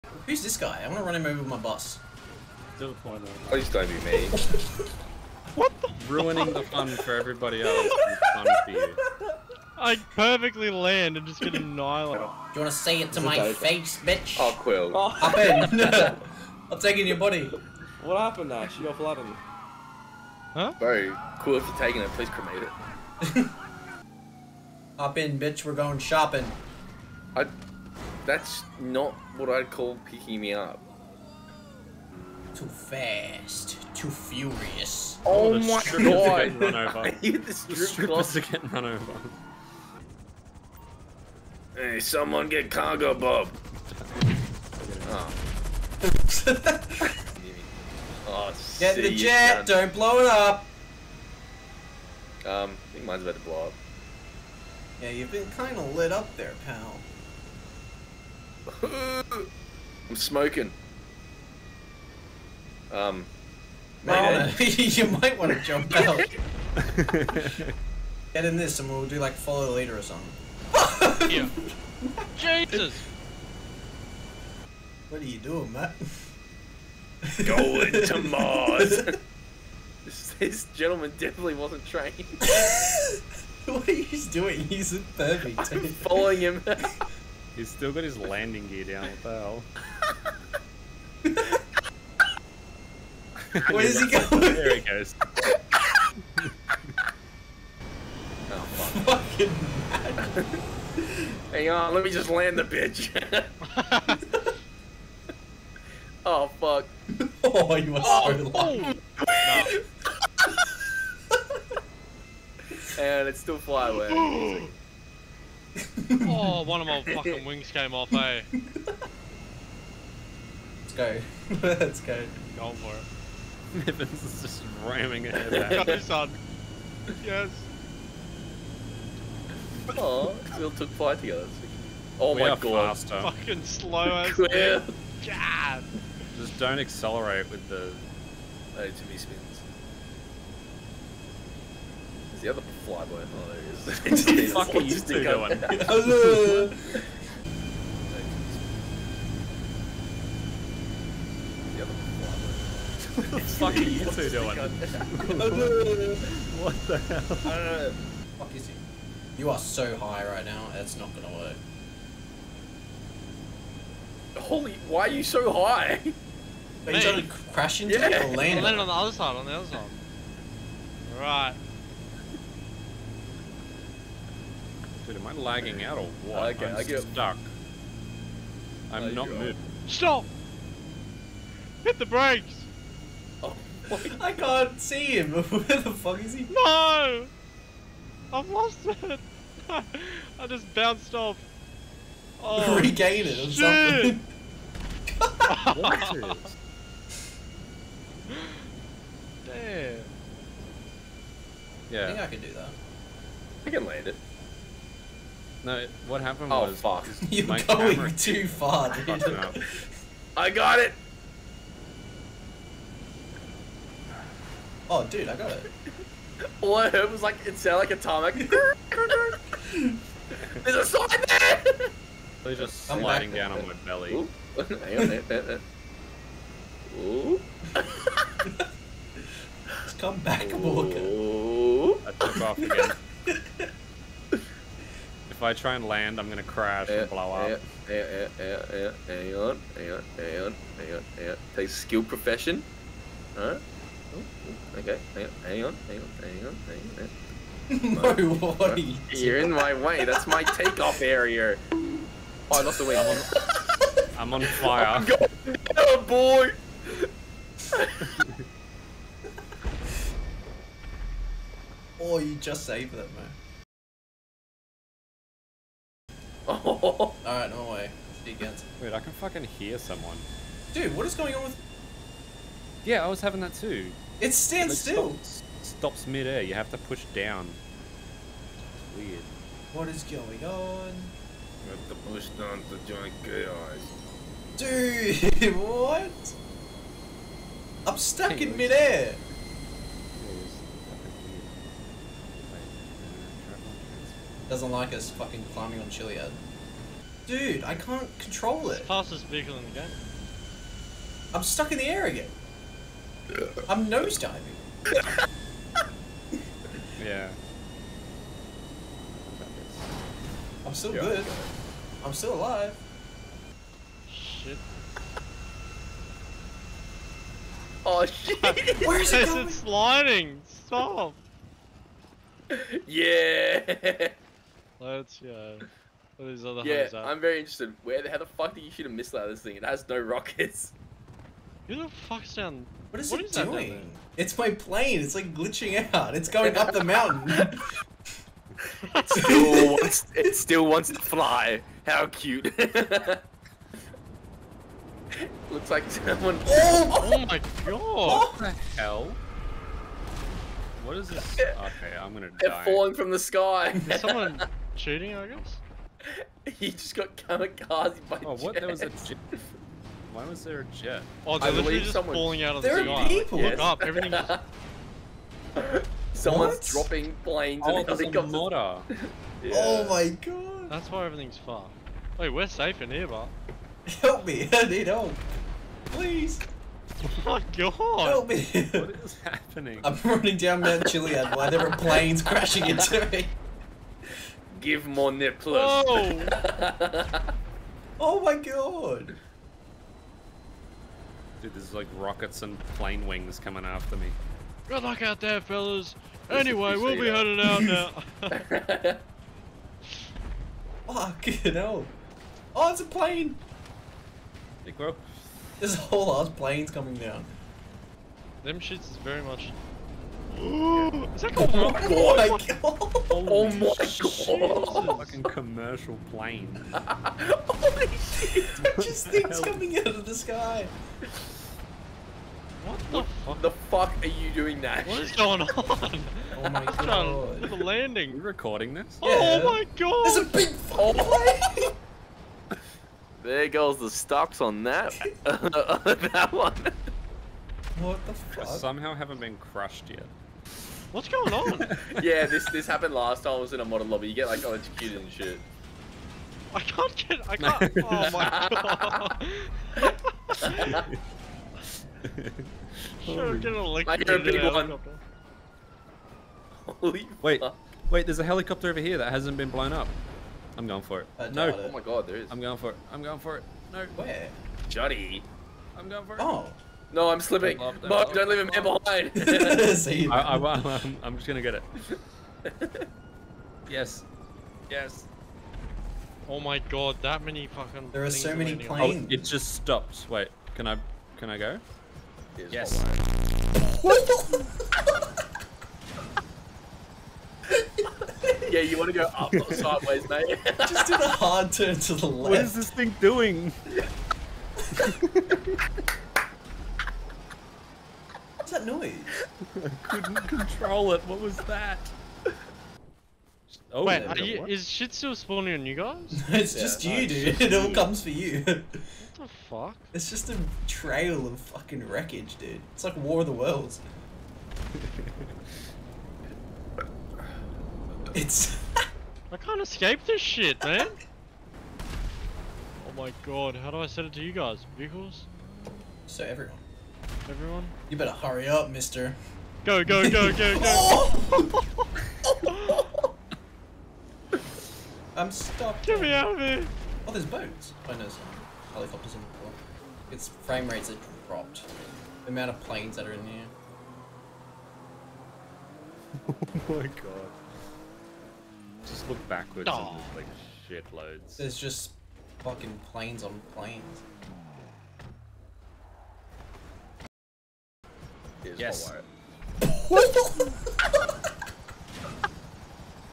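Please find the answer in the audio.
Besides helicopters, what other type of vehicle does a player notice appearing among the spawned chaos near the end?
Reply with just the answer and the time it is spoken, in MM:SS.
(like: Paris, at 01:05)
boats, at 08:57.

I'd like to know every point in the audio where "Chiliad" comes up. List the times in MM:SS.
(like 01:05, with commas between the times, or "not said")
04:55, 06:20.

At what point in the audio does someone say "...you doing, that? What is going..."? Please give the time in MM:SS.
07:04.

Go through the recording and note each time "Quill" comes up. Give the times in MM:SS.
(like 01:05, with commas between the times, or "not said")
00:14, 00:21.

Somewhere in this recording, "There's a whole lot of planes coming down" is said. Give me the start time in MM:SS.
06:45.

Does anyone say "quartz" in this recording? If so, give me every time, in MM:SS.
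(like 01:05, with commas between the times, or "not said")
not said.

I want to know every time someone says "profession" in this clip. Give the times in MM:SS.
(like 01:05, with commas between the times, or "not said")
04:02.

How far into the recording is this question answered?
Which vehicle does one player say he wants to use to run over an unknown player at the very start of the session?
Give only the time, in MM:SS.
00:01.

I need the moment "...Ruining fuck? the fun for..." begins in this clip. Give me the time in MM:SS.
00:06.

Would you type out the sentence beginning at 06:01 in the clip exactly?
Oh, they're I literally just someone...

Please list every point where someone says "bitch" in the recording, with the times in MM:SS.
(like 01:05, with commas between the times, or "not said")
00:13, 00:25, 01:42.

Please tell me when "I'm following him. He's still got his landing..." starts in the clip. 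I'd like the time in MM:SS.
01:25.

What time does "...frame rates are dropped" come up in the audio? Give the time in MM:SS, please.
09:00.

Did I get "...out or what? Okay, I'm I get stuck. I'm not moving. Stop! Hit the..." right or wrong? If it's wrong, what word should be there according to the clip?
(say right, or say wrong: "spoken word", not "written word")
right.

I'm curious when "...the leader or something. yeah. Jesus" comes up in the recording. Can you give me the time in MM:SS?
01:09.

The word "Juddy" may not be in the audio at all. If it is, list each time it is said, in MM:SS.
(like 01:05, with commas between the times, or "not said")
07:44.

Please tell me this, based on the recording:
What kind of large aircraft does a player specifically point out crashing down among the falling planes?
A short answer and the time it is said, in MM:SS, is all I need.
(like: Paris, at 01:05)
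commercial plane, at 06:55.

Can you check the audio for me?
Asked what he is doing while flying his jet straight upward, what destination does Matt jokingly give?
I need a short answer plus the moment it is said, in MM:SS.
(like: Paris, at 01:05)
Mars, at 01:18.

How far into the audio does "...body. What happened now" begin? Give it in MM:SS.
00:17.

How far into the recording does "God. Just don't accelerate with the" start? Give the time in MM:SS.
02:15.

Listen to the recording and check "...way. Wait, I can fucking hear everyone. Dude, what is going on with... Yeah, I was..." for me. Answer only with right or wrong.
wrong.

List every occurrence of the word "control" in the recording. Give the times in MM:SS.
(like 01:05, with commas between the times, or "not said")
04:58, 08:20.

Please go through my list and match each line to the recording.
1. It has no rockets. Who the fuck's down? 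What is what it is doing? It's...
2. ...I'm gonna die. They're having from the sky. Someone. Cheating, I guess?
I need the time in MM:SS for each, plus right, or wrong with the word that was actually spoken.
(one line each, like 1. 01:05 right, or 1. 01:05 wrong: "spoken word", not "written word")
1. 05:29 right
2. 05:52 wrong: "falling", not "having".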